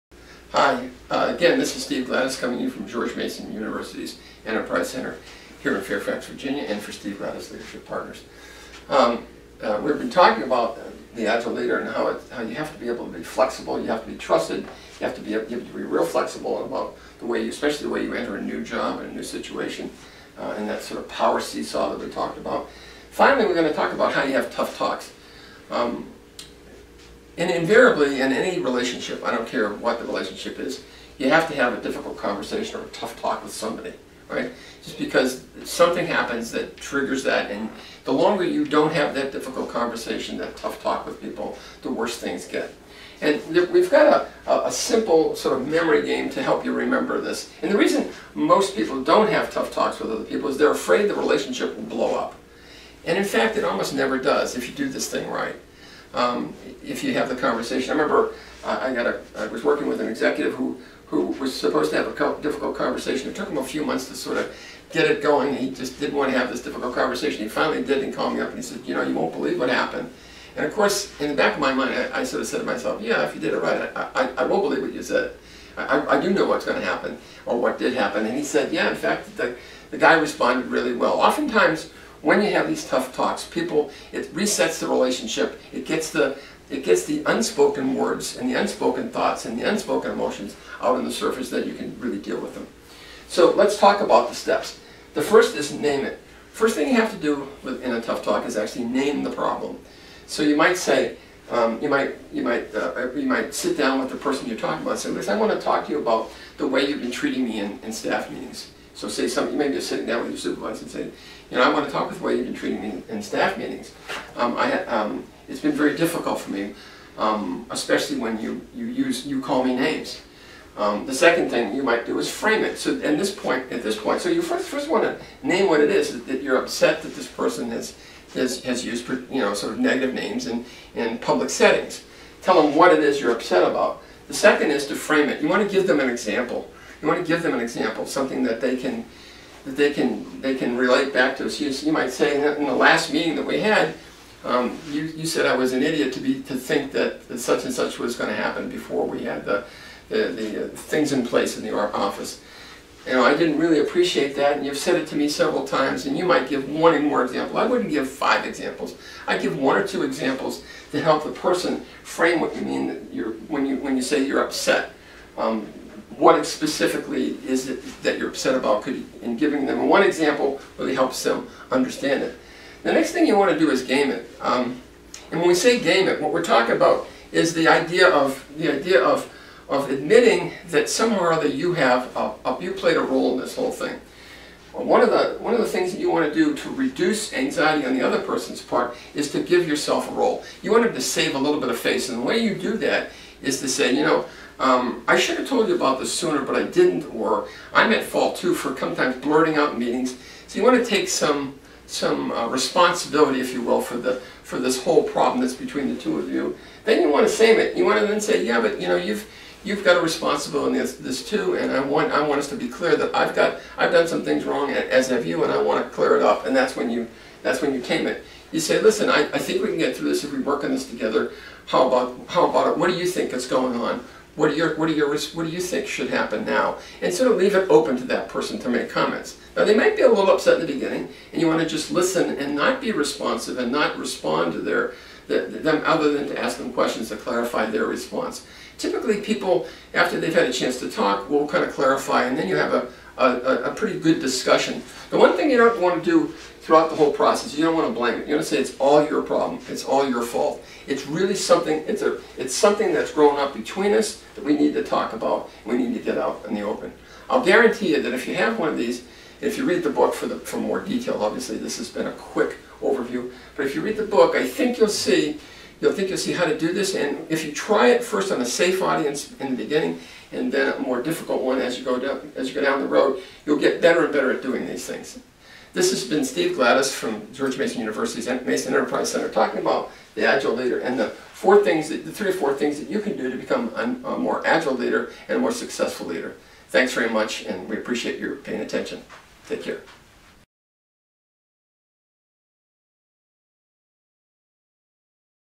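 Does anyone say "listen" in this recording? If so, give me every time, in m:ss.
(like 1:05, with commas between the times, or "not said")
1:45, 3:38, 3:51.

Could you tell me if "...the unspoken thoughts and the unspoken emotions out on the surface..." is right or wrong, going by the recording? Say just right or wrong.
right.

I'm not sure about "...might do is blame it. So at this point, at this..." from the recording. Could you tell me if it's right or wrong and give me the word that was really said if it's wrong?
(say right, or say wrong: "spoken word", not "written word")
wrong: "frame", not "blame".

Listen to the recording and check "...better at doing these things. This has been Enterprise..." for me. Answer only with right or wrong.
wrong.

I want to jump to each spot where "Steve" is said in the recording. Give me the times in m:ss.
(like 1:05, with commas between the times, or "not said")
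0:01, 0:06, 4:36.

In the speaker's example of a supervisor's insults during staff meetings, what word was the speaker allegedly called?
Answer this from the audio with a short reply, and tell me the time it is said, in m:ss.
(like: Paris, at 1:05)
An idiot, at 2:25.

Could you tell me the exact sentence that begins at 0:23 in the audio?
Finally, we're going to talk about how you have tough talks.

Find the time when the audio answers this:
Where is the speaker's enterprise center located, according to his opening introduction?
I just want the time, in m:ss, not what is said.
0:05.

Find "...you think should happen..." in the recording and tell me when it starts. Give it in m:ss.
3:45.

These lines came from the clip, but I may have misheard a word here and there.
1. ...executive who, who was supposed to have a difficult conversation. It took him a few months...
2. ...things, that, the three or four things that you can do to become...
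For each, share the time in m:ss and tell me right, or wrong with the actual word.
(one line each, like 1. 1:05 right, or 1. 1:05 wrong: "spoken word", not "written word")
1. 1:00 right
2. 4:41 right.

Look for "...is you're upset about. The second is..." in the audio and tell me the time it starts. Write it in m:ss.
2:12.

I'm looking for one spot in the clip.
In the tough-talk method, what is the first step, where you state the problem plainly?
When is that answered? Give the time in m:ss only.
1:35.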